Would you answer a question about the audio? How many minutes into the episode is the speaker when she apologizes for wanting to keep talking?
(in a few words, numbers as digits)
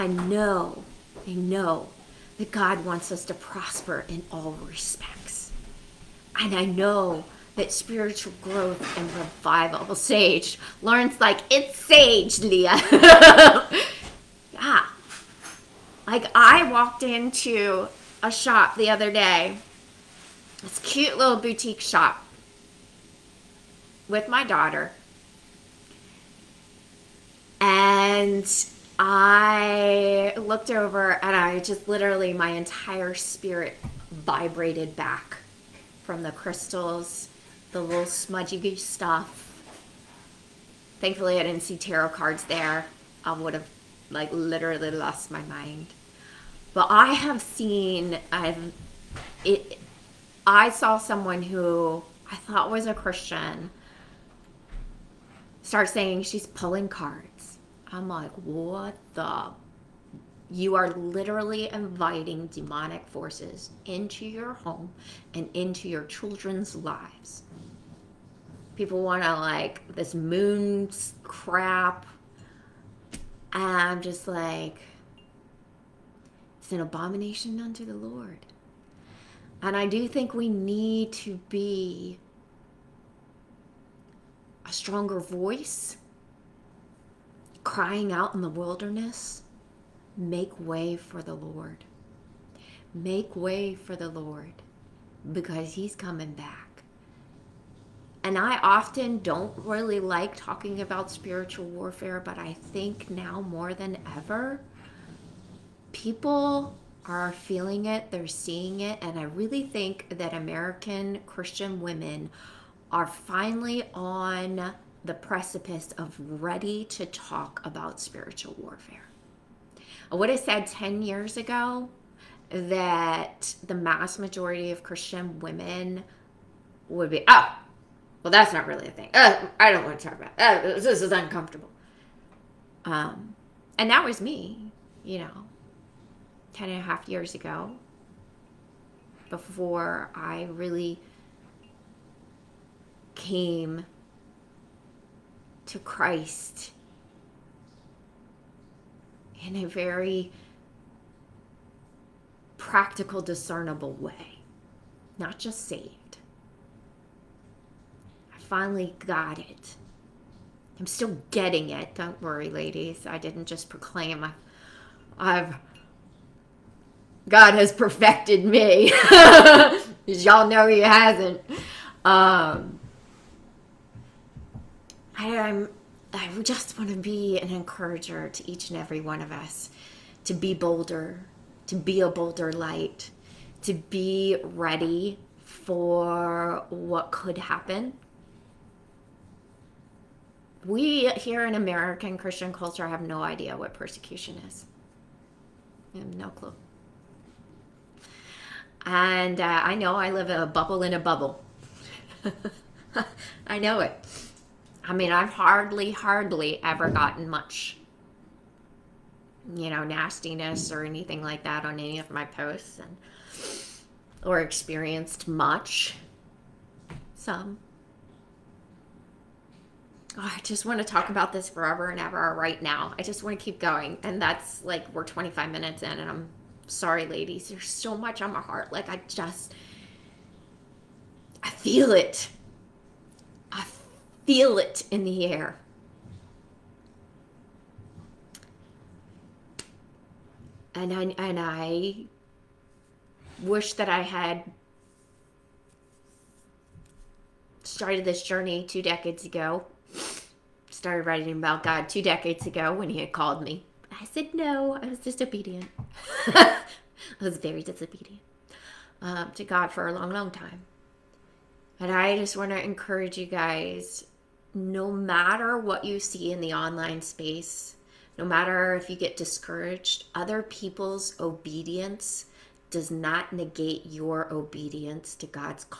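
25.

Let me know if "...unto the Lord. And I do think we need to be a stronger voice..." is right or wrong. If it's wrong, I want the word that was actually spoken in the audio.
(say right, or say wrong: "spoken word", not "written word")
right.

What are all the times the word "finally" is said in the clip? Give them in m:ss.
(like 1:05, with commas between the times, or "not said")
1:53, 2:38.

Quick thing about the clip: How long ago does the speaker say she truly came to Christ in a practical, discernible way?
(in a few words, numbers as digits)
10 and a half years ago.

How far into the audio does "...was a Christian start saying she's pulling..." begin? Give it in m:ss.
0:52.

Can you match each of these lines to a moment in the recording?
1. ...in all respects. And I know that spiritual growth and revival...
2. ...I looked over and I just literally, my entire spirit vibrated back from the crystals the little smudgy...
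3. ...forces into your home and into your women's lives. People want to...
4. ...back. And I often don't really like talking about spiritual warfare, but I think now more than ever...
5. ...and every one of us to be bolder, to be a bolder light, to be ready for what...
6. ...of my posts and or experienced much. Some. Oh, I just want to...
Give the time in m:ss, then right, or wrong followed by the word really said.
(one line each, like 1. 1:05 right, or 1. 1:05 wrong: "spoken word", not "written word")
1. 0:04 right
2. 0:28 right
3. 1:03 wrong: "children", not "women"
4. 1:36 right
5. 2:58 right
6. 3:32 right.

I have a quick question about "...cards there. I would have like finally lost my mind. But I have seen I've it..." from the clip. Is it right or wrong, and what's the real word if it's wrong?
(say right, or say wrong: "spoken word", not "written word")
wrong: "literally", not "finally".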